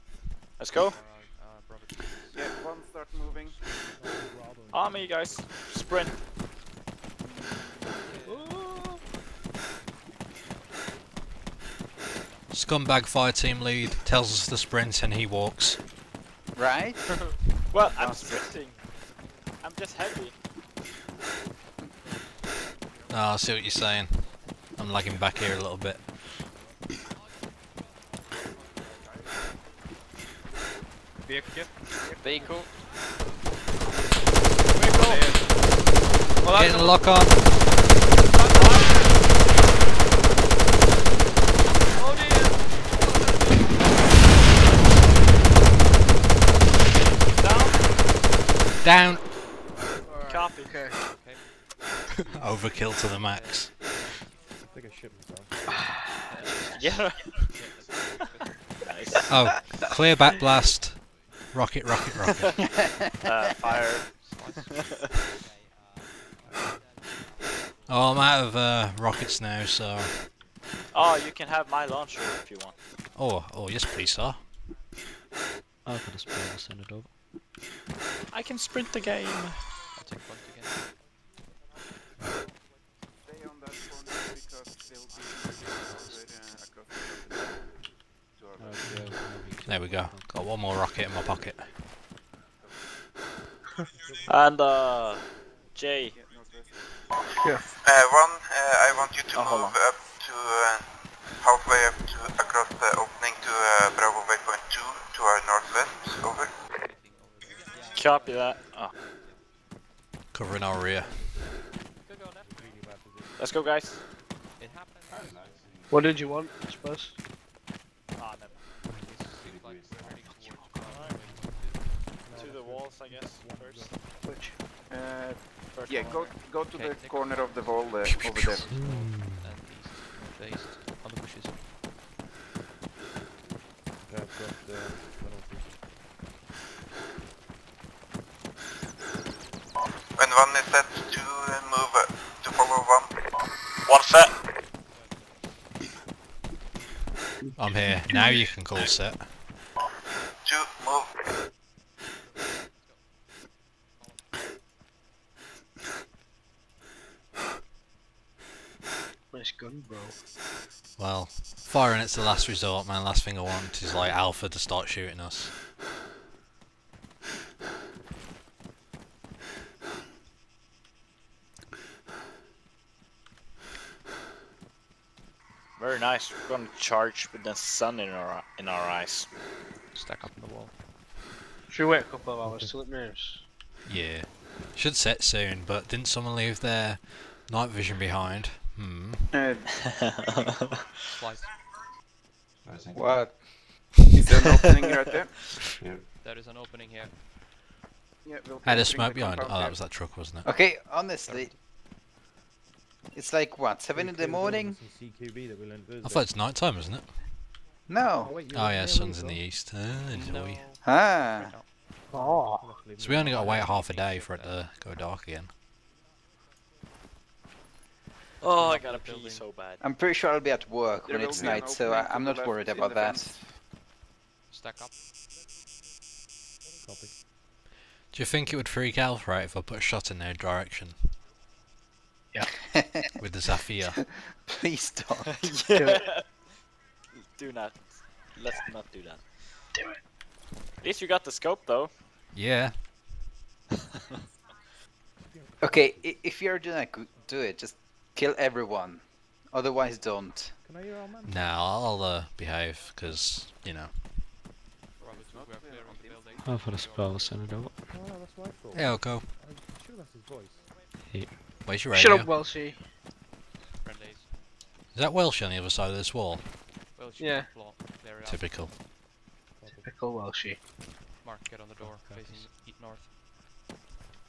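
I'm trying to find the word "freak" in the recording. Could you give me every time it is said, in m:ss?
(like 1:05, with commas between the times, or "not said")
3:48.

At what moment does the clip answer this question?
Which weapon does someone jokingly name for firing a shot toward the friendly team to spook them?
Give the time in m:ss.
3:53.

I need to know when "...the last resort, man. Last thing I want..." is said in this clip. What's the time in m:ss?
2:42.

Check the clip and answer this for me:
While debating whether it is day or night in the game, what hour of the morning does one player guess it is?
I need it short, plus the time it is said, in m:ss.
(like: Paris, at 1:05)
7, at 3:23.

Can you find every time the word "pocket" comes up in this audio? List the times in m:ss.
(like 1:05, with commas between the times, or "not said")
1:31.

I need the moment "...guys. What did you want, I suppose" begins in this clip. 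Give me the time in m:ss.
1:53.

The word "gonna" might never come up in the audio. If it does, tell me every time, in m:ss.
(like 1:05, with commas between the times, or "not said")
2:56, 4:06.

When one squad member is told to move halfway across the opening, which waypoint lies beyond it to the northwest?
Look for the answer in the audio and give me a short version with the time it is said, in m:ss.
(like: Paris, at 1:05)
Bravo Waypoint 2, at 1:43.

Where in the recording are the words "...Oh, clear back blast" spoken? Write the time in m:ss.
0:59.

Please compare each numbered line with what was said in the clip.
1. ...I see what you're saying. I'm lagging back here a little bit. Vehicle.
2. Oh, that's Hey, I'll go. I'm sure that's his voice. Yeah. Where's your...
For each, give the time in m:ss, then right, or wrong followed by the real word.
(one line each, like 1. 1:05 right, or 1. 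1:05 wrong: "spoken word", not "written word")
1. 0:23 right
2. 4:17 right.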